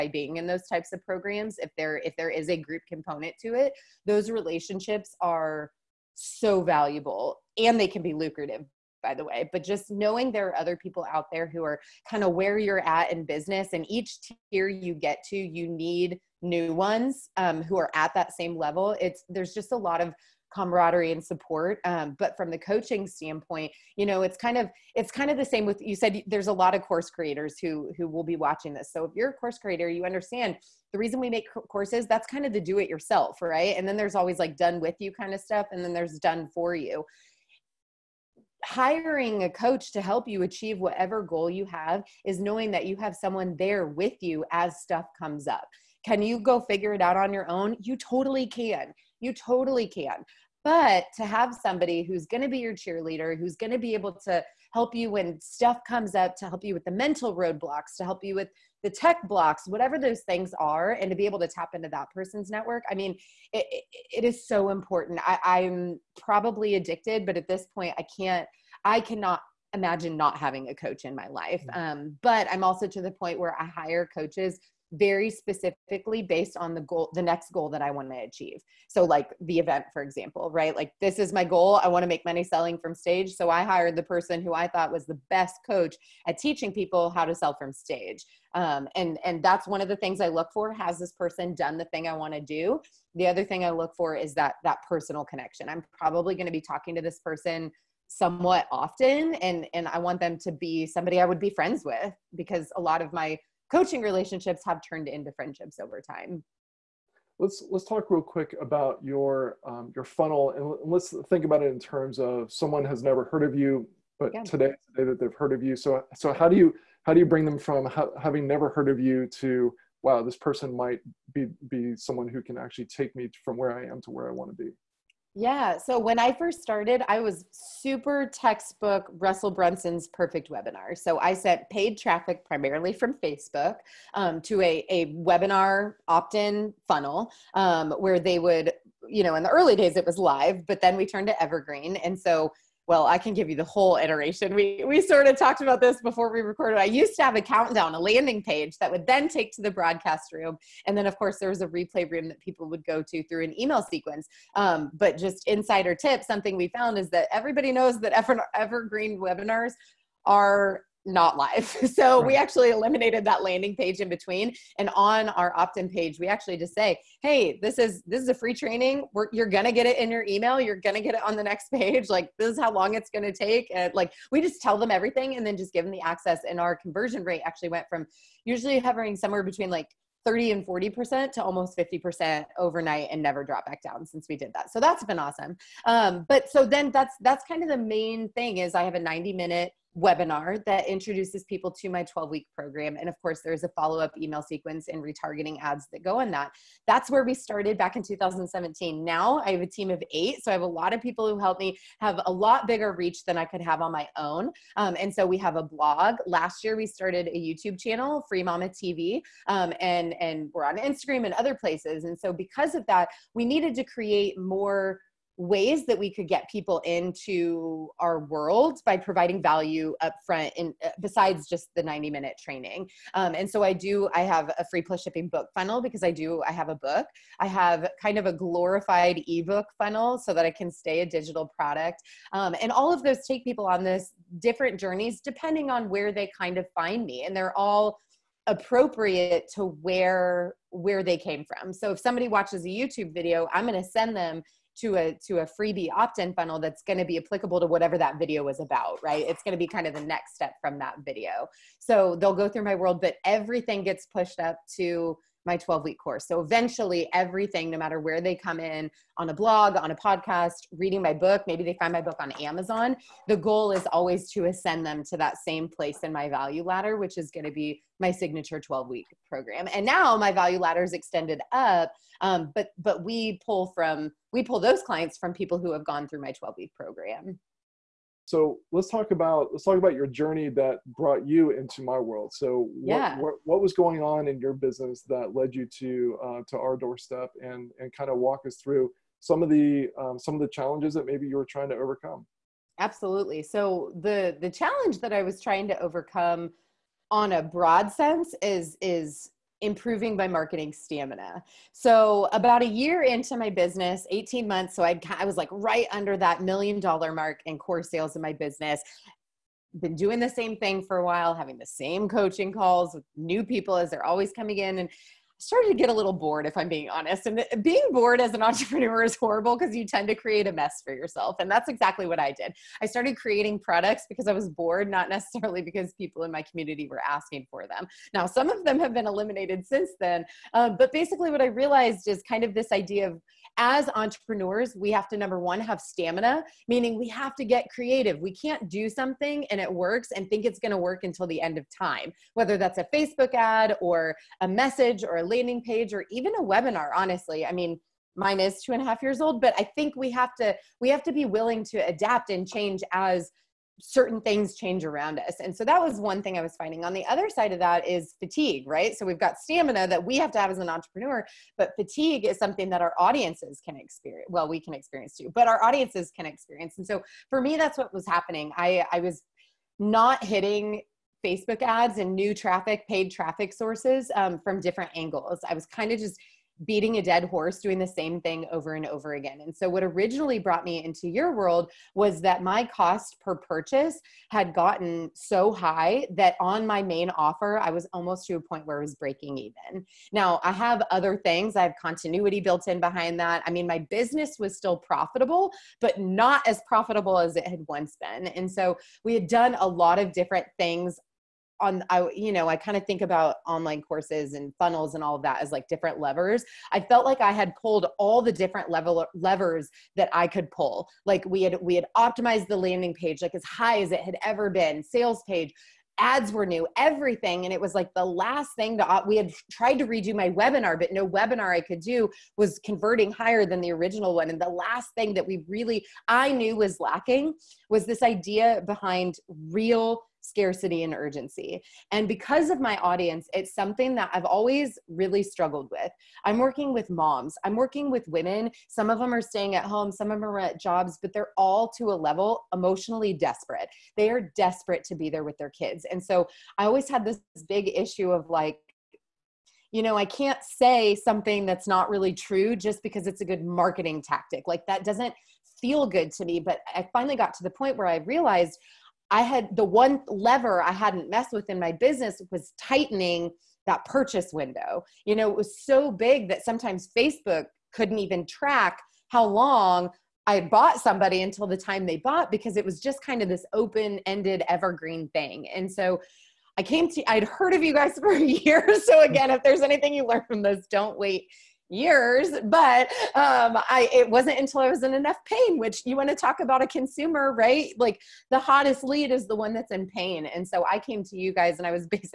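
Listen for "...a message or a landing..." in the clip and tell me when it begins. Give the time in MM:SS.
05:44.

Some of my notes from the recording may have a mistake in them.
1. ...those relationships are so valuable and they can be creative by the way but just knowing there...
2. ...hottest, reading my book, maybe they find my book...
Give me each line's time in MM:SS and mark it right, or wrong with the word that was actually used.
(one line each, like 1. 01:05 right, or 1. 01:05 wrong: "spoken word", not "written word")
1. 00:04 wrong: "lucrative", not "creative"
2. 04:19 wrong: "podcast", not "hottest".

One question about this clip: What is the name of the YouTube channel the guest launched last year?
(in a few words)
Free Mama TV.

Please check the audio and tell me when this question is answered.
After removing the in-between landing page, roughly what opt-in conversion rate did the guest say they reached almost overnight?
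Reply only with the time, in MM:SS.
03:01.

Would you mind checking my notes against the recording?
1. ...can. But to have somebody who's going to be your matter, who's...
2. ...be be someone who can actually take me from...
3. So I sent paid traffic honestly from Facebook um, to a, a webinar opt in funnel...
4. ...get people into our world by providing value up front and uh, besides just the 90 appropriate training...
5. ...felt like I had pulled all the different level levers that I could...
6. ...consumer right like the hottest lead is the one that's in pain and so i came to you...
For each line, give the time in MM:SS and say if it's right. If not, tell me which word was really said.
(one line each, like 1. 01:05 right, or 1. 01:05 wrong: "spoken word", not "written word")
1. 00:49 wrong: "cheerleader", not "matter"
2. 02:01 right
3. 02:10 wrong: "primarily", not "honestly"
4. 03:36 wrong: "minute", not "appropriate"
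5. 06:46 right
6. 08:06 right.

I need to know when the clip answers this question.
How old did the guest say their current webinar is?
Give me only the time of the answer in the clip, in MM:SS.
05:48.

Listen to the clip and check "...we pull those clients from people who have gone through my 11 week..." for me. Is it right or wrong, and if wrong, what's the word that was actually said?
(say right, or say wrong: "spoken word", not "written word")
wrong: "12", not "11".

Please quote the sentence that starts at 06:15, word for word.
I was kind of just beating a dead horse, doing the same thing over and over again.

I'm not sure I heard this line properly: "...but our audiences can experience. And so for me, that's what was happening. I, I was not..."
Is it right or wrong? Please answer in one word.
right.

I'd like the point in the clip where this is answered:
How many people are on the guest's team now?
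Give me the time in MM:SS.
03:20.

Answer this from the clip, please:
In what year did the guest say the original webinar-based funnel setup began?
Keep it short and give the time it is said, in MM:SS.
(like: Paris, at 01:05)
2017, at 03:18.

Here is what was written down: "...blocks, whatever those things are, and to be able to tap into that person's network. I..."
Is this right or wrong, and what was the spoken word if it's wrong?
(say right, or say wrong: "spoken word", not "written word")
right.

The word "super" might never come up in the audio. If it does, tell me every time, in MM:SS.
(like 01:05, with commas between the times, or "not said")
02:07.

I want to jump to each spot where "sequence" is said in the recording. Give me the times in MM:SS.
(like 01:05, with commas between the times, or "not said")
02:33, 03:14.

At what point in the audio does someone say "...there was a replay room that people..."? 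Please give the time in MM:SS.
02:31.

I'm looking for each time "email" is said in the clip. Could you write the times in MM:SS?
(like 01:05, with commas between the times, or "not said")
02:33, 02:50, 03:14.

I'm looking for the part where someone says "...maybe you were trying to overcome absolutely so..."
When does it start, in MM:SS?
04:51.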